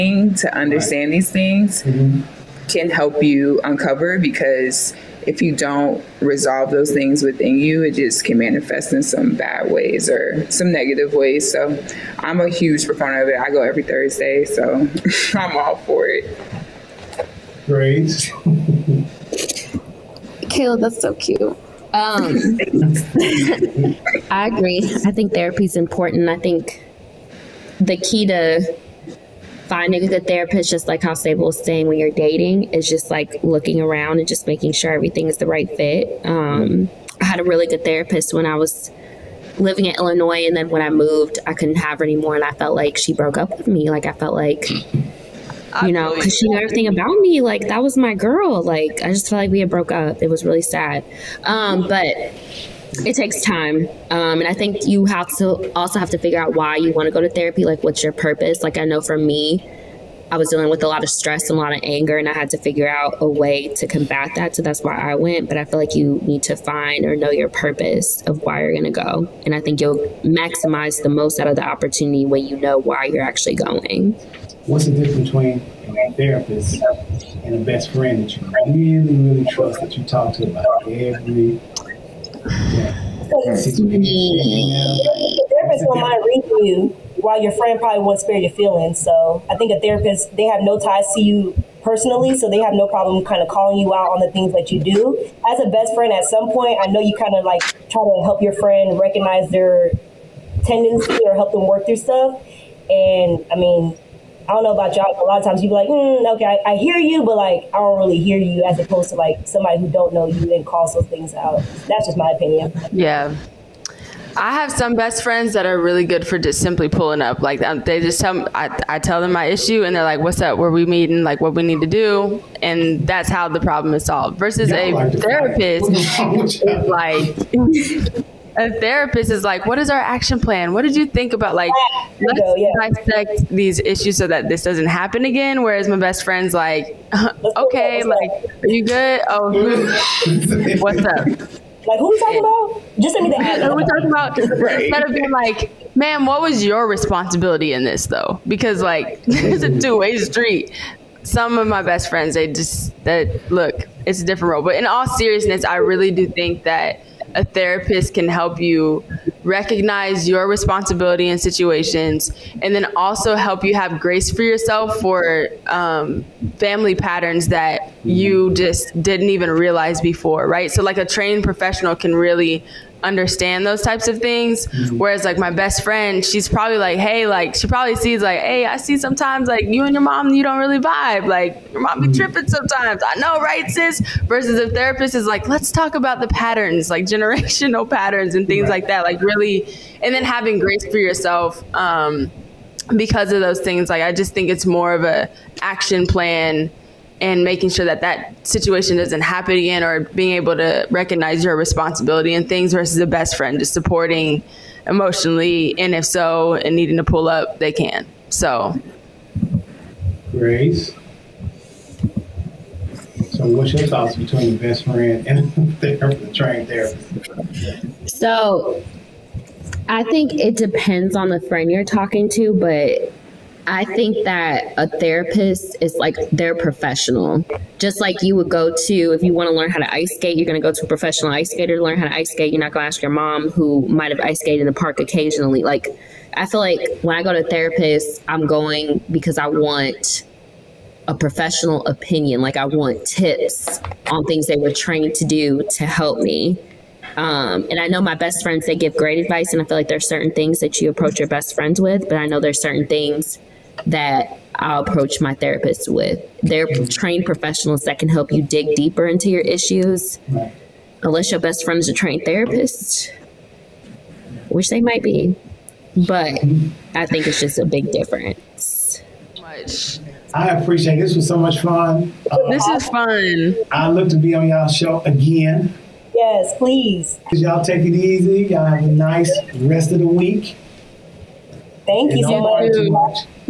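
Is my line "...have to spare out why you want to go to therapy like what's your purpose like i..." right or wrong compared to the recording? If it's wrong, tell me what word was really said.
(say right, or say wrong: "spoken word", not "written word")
wrong: "figure", not "spare".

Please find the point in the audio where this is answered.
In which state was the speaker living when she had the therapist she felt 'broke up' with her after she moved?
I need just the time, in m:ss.
0:39.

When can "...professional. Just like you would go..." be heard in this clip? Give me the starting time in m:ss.
3:46.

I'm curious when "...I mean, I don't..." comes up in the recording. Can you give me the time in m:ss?
1:43.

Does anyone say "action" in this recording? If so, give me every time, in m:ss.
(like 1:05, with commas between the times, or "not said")
2:09, 3:15.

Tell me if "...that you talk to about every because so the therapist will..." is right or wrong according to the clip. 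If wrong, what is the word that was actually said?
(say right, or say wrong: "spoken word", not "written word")
right.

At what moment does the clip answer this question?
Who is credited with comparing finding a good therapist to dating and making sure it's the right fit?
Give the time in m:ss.
0:31.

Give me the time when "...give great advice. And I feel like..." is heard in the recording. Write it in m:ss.
4:08.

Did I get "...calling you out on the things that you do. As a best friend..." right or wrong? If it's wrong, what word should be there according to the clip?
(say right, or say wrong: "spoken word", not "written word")
right.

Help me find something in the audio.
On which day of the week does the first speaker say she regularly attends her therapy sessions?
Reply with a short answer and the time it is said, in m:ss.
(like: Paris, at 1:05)
Thursday, at 0:13.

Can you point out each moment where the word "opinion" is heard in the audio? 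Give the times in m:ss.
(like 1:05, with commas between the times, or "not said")
1:52, 4:01.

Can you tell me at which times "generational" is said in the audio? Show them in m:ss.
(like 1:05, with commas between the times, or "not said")
3:07.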